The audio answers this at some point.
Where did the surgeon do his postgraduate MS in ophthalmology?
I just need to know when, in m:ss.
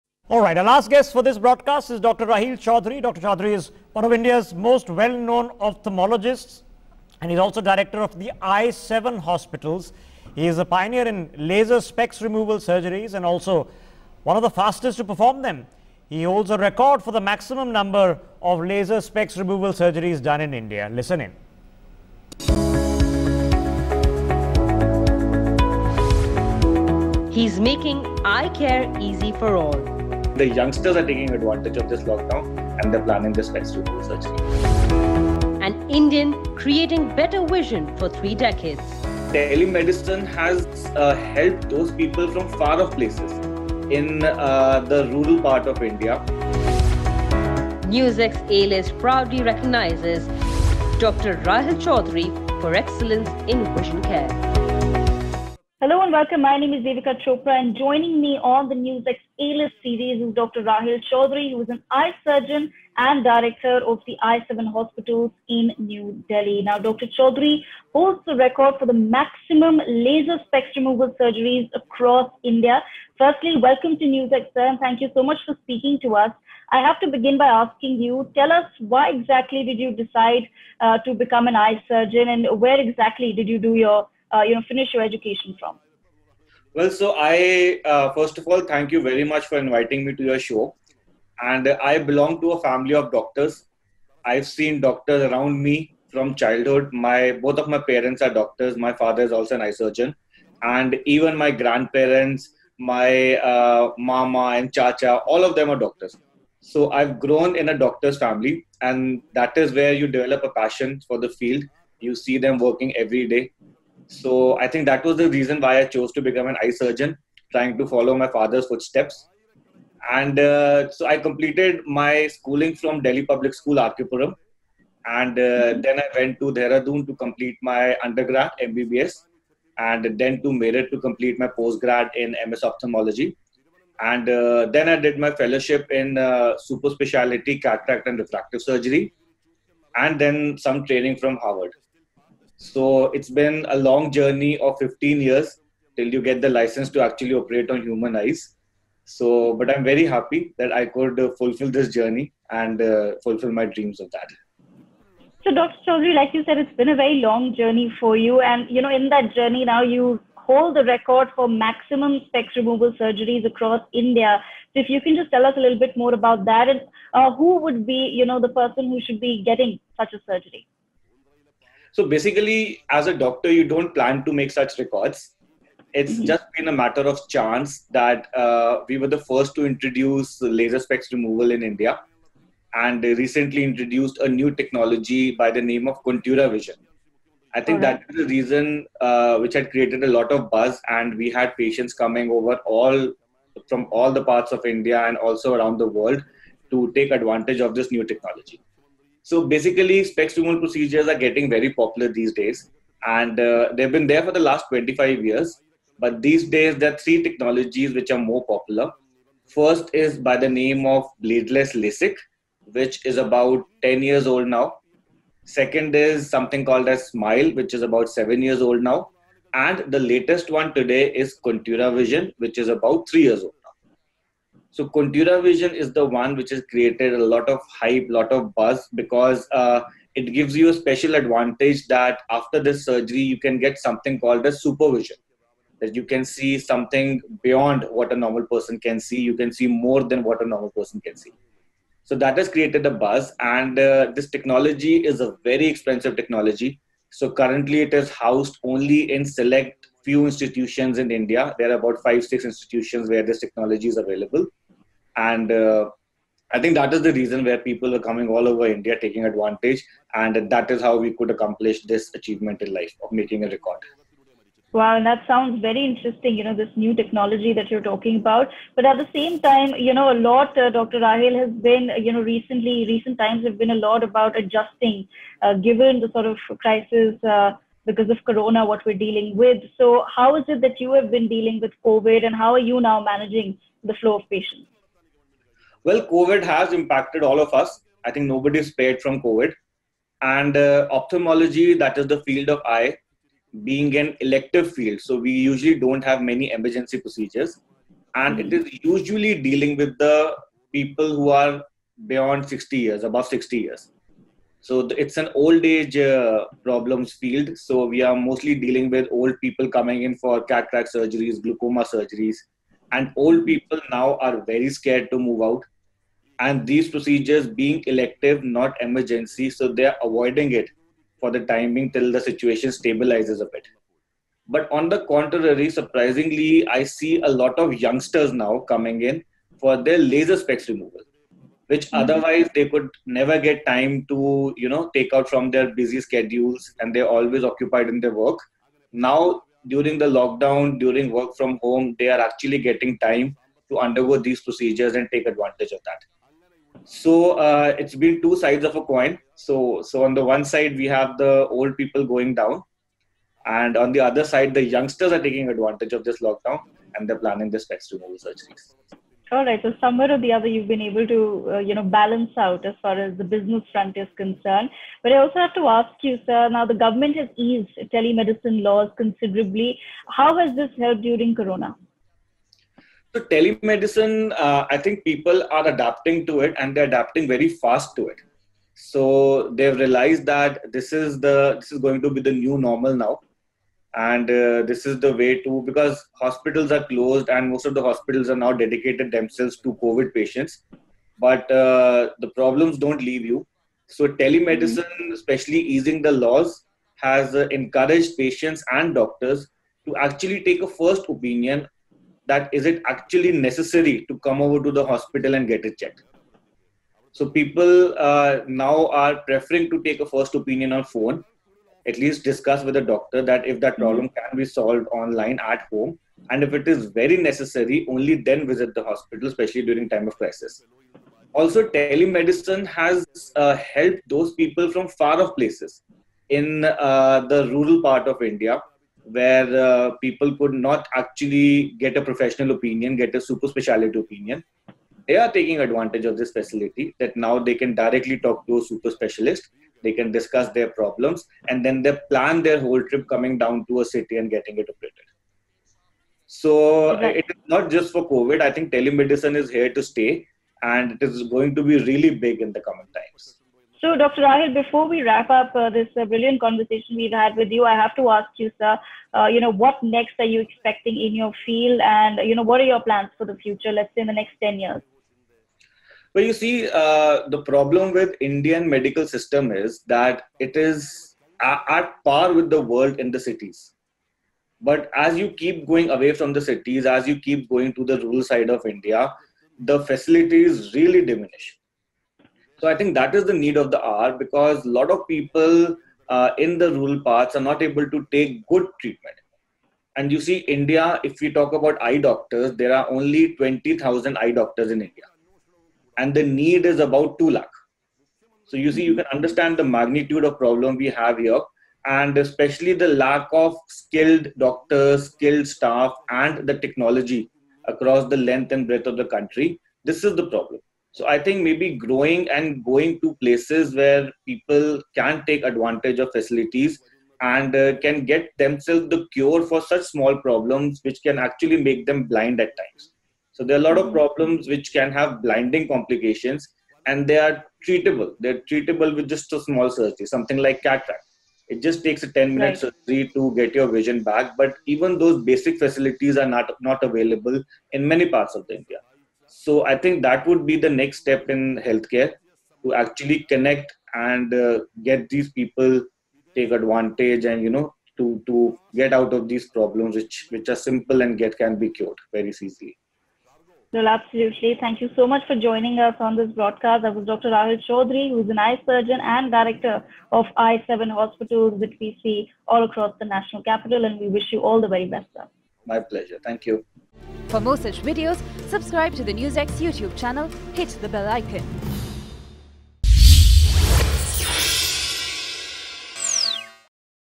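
2:10.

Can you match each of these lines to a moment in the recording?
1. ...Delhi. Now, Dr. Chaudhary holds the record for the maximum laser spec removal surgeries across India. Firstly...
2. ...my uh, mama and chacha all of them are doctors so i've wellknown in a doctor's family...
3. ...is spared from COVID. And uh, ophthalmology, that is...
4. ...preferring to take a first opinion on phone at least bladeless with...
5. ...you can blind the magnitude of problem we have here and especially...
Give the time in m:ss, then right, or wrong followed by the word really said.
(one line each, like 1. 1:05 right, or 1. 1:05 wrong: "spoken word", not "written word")
1. 1:06 right
2. 1:42 wrong: "grown", not "wellknown"
3. 4:48 right
4. 6:49 wrong: "discuss", not "bladeless"
5. 8:18 wrong: "understand", not "blind".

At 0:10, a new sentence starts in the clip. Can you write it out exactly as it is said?
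He is a pioneer in laser specs removal surgeries and also one of the fastest to perform them.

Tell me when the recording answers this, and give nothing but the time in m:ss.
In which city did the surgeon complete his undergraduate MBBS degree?
2:06.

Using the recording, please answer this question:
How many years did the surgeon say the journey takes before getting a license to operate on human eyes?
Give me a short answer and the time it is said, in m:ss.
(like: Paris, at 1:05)
15 years, at 2:24.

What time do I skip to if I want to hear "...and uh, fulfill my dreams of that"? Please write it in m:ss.
2:32.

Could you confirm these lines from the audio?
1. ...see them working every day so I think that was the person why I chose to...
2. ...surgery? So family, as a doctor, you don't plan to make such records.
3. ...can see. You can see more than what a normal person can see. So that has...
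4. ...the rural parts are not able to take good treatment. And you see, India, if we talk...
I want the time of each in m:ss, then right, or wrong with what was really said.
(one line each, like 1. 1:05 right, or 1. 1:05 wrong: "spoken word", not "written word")
1. 1:52 wrong: "reason", not "person"
2. 2:50 wrong: "basically", not "family"
3. 3:58 right
4. 8:06 right.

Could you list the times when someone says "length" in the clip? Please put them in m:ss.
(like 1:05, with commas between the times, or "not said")
8:28.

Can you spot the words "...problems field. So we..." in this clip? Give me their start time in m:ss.
5:06.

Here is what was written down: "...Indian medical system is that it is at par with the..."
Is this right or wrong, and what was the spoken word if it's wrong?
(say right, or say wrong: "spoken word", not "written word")
right.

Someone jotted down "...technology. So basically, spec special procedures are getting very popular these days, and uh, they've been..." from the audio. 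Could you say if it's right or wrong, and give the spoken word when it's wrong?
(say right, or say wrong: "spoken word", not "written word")
wrong: "removal", not "special".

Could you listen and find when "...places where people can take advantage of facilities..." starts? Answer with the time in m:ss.
8:33.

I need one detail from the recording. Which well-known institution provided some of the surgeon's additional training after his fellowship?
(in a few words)
Harvard.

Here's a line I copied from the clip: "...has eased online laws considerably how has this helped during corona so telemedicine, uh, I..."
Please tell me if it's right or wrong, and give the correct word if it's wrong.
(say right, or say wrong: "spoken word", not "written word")
wrong: "telemedicine", not "online".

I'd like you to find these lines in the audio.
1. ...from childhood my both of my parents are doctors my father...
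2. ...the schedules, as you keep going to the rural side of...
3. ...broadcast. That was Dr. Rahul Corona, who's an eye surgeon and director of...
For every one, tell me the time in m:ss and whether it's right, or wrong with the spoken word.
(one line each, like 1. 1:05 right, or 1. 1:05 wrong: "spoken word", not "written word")
1. 1:36 right
2. 7:56 wrong: "cities", not "schedules"
3. 9:16 wrong: "Chaudhary", not "Corona".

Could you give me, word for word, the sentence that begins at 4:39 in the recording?
So, how is it that you have been dealing with COVID and how are you now managing the flow of patients?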